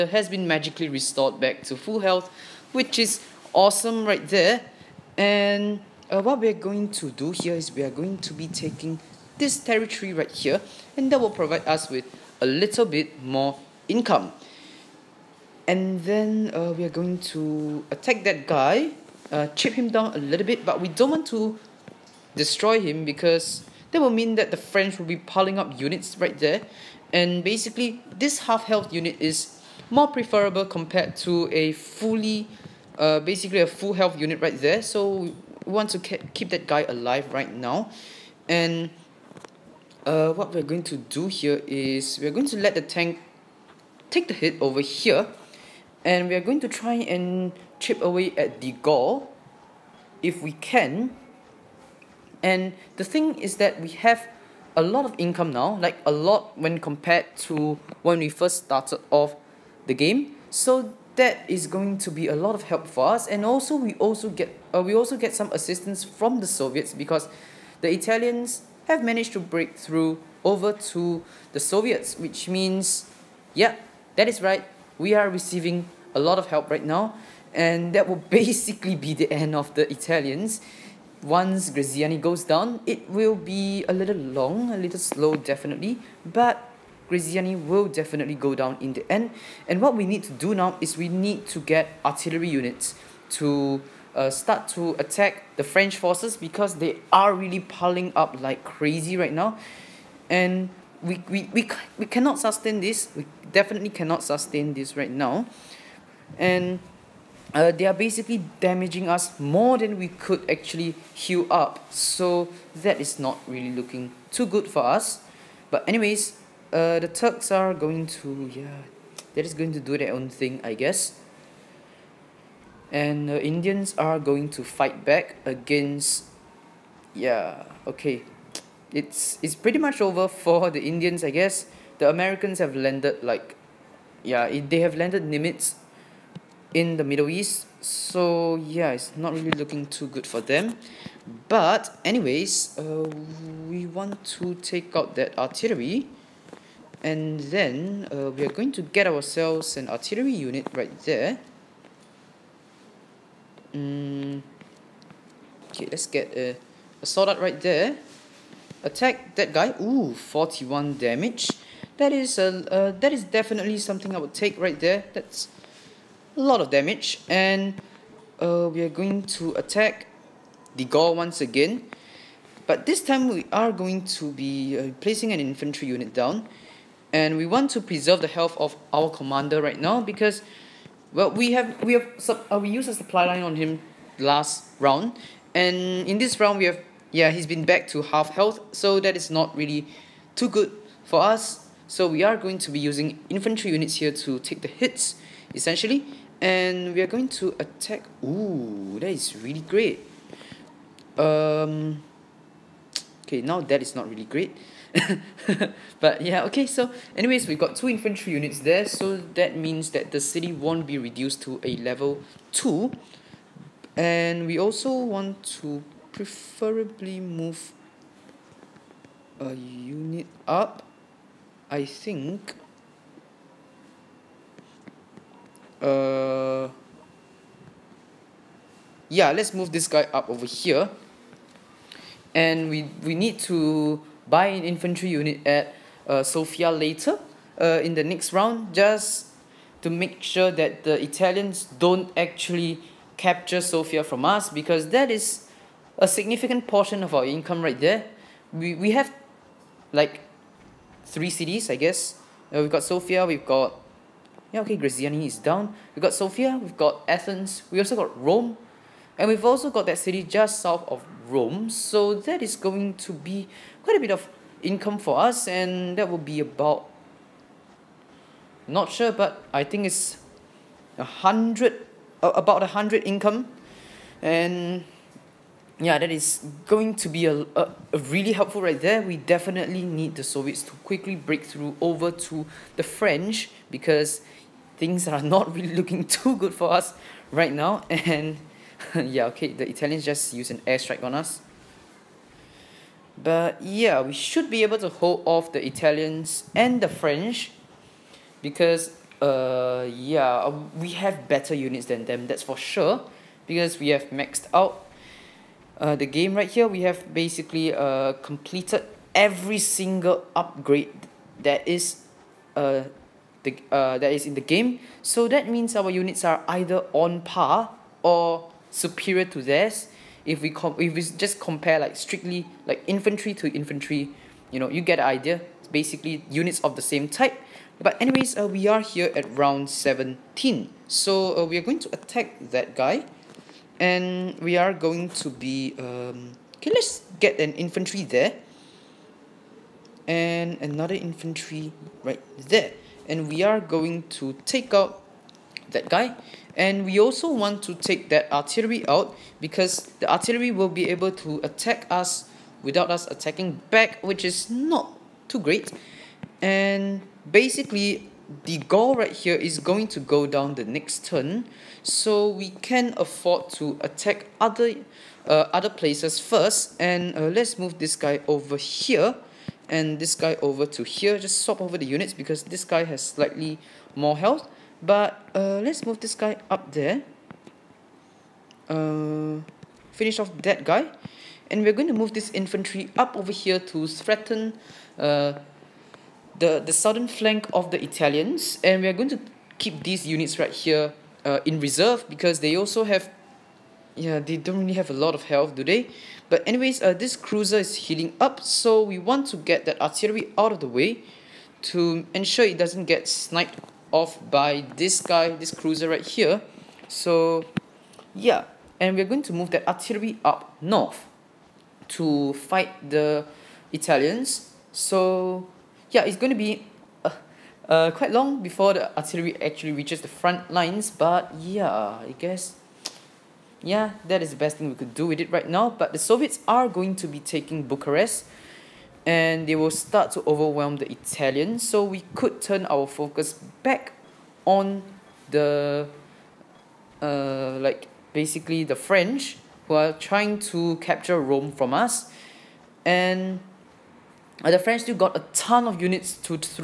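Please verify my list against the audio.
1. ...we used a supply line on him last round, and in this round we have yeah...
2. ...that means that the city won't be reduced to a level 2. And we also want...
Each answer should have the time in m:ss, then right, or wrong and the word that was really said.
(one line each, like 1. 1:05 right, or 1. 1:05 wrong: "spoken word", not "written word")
1. 3:02 right
2. 3:29 right.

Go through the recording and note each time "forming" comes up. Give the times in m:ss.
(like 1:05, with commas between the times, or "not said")
not said.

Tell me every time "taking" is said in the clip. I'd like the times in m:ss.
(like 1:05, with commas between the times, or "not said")
0:08, 7:07.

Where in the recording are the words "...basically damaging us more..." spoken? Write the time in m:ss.
1:47.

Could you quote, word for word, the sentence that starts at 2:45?
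That's a lot of damage, and uh, we are going to attack the Gaul once again.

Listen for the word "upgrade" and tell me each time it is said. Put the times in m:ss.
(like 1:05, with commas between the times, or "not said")
5:10.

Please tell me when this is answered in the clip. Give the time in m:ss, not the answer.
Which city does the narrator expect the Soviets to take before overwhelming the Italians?
7:07.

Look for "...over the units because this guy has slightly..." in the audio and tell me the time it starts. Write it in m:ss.
6:11.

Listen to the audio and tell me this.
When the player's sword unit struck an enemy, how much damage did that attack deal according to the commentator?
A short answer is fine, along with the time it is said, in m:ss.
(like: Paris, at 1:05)
41, at 2:40.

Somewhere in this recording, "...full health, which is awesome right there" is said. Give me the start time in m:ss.
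0:01.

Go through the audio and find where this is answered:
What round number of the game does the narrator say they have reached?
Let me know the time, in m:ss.
5:29.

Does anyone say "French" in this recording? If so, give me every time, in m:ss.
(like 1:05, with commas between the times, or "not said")
0:24, 1:35, 4:42, 4:56, 7:18, 7:24.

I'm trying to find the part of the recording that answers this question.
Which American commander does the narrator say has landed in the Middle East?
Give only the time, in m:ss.
2:15.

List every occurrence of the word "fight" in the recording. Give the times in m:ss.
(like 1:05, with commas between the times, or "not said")
2:04, 6:52.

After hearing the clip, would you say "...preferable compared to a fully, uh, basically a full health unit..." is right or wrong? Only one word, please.
right.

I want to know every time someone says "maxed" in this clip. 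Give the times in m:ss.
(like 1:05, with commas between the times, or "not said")
5:04.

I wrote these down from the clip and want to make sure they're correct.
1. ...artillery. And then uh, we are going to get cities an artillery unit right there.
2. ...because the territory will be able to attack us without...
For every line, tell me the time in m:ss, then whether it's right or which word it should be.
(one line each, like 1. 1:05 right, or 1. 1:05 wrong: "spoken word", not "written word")
1. 2:25 wrong: "ourselves", not "cities"
2. 5:49 wrong: "artillery", not "territory".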